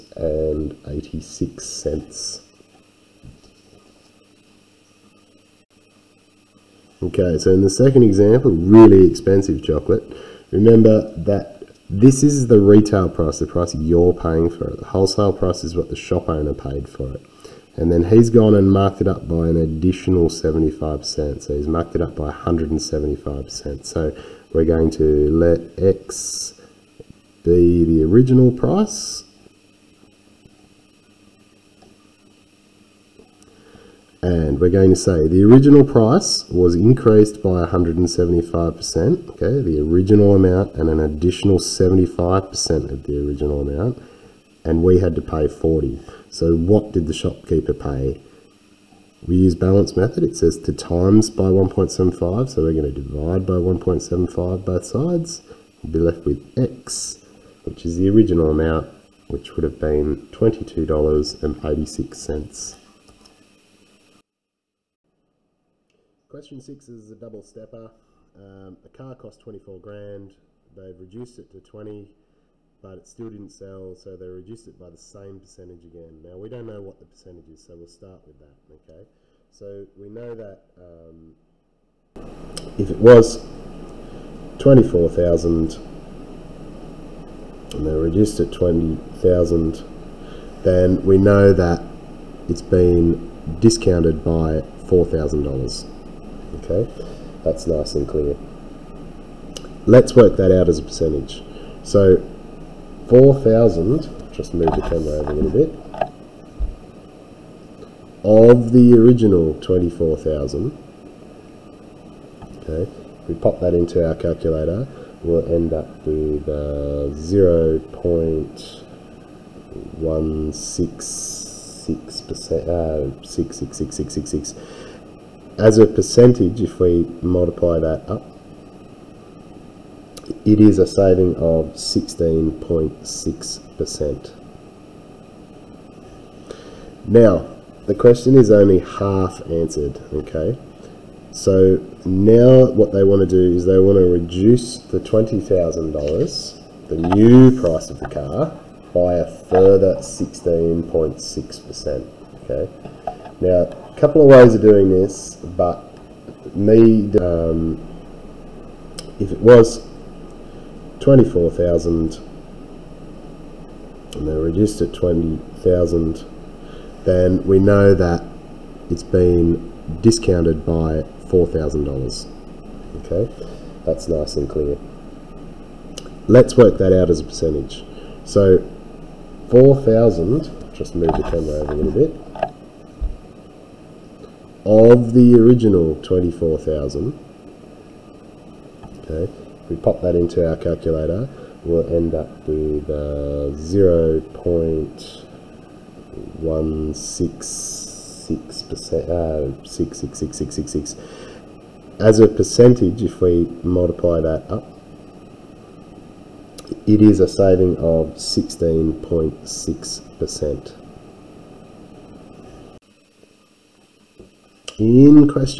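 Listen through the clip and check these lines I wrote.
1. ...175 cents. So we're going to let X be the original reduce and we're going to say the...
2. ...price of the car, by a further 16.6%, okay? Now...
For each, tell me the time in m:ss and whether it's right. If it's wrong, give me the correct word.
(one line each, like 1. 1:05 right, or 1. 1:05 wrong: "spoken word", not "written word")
1. 0:22 wrong: "price", not "reduce"
2. 2:27 right.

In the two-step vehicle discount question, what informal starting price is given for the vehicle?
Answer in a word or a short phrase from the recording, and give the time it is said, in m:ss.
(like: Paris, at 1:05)
24 grand, at 1:09.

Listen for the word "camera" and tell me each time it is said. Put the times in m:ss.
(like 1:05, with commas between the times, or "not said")
1:44, 3:01.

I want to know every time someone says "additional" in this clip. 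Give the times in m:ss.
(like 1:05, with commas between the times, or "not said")
0:19, 0:40.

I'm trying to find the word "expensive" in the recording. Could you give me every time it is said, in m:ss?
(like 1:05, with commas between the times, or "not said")
0:09.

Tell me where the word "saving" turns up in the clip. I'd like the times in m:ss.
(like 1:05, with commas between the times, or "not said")
2:10, 3:27.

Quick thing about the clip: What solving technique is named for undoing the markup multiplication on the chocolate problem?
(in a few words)
balance method.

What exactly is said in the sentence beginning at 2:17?
Now, the question is only half answered, okay?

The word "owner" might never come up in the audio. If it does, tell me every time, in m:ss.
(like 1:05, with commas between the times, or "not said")
0:16.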